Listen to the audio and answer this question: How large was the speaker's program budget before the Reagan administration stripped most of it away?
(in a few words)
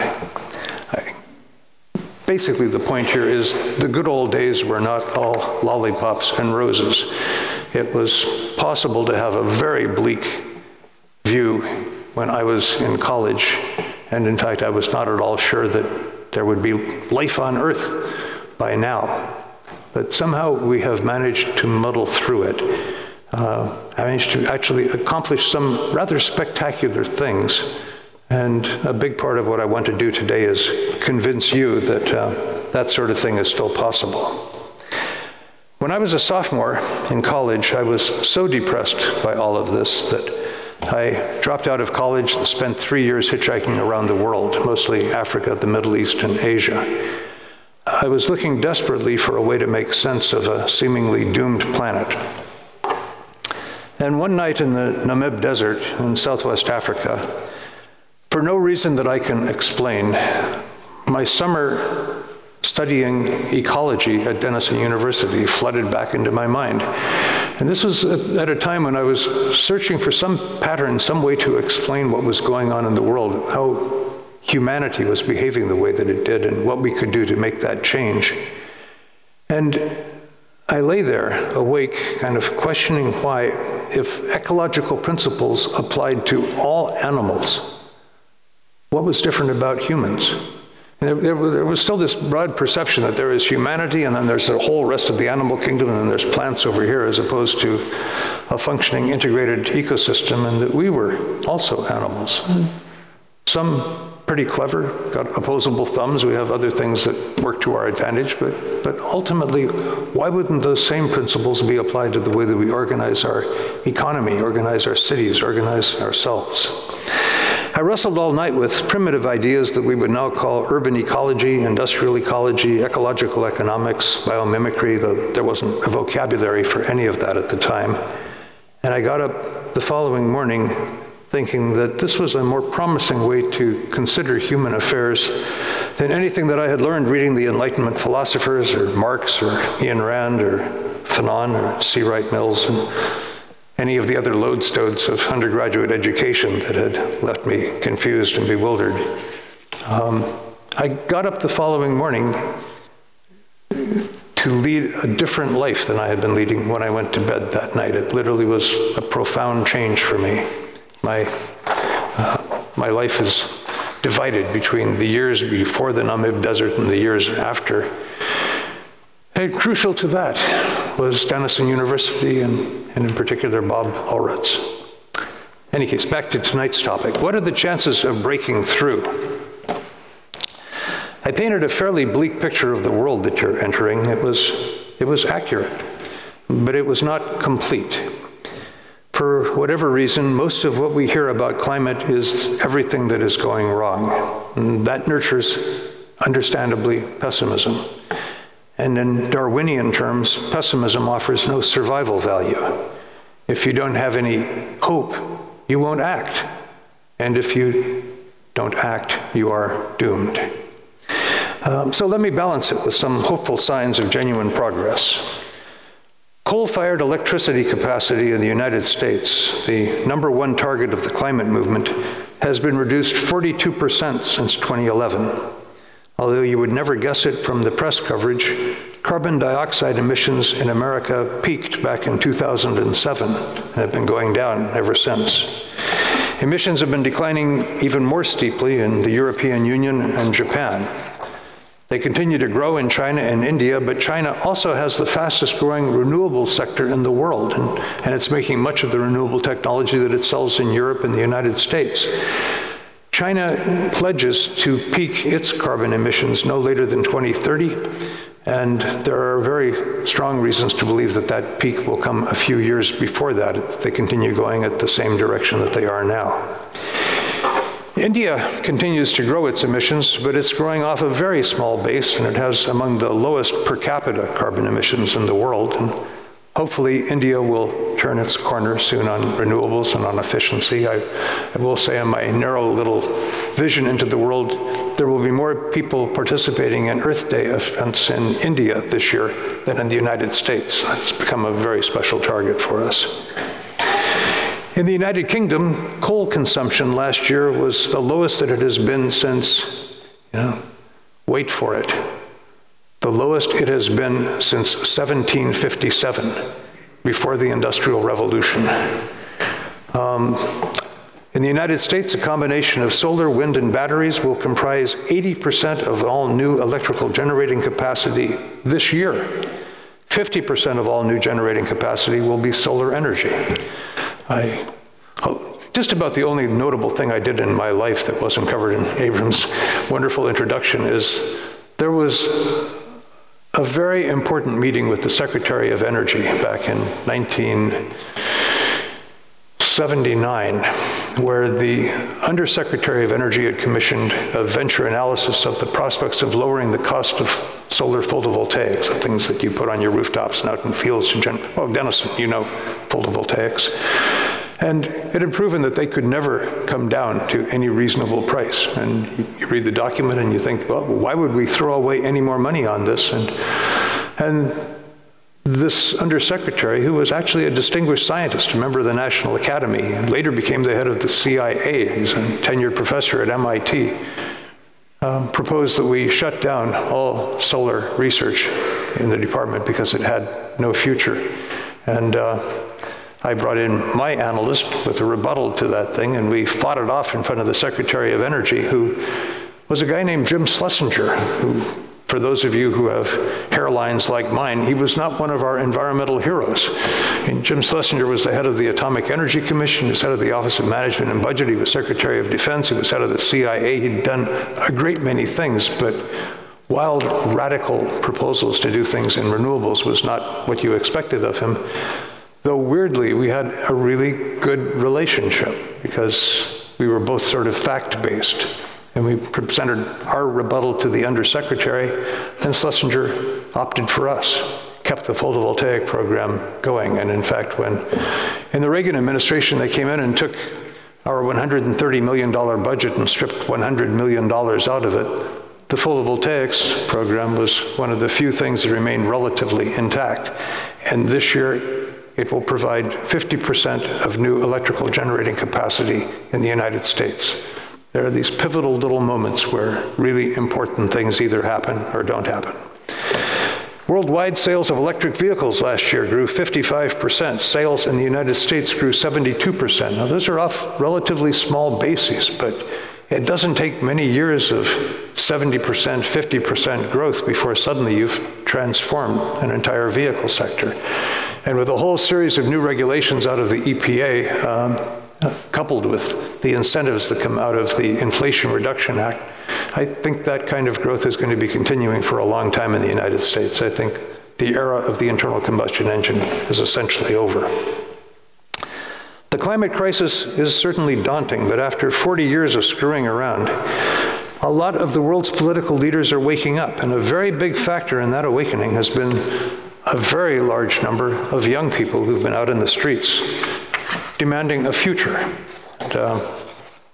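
$130 million.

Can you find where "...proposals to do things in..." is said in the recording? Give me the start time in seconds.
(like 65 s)
408 s.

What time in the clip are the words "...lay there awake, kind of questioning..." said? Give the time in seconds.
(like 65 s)
80 s.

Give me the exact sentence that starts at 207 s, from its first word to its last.
And if you don't act, you are doomed.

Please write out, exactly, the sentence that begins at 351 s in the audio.
In gen- oh, Denison, you know photovoltaics.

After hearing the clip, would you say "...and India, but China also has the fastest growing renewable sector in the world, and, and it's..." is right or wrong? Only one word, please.
right.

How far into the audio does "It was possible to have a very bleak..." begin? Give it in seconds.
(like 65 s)
7 s.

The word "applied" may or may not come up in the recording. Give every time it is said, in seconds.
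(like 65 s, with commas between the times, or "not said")
85 s, 111 s.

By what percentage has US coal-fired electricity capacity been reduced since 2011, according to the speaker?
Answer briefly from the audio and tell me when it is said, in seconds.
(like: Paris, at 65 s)
42%, at 223 s.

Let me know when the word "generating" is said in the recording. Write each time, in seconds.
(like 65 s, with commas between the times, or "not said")
317 s, 321 s, 444 s.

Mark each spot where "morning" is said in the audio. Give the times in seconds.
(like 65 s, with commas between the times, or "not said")
130 s, 151 s.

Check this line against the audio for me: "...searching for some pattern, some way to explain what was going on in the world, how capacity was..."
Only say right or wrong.
wrong.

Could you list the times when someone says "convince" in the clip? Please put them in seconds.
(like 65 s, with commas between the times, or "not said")
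31 s.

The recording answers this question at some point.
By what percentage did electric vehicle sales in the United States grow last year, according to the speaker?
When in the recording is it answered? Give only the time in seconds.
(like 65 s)
458 s.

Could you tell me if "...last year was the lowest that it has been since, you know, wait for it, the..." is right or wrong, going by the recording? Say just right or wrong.
right.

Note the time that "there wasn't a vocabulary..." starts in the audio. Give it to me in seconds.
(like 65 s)
125 s.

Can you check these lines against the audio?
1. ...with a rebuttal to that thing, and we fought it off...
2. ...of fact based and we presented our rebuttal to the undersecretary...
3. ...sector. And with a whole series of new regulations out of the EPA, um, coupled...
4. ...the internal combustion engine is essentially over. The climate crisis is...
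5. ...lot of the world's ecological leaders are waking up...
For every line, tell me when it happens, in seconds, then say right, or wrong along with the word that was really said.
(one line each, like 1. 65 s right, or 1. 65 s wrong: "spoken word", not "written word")
1. 384 s right
2. 417 s right
3. 470 s right
4. 484 s right
5. 494 s wrong: "political", not "ecological".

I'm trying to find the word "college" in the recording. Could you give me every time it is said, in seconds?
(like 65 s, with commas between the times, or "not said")
12 s, 37 s, 41 s.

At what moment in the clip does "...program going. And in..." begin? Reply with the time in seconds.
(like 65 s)
425 s.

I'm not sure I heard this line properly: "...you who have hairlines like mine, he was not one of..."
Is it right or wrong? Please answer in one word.
right.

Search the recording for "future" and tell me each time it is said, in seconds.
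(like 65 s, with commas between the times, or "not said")
380 s, 504 s.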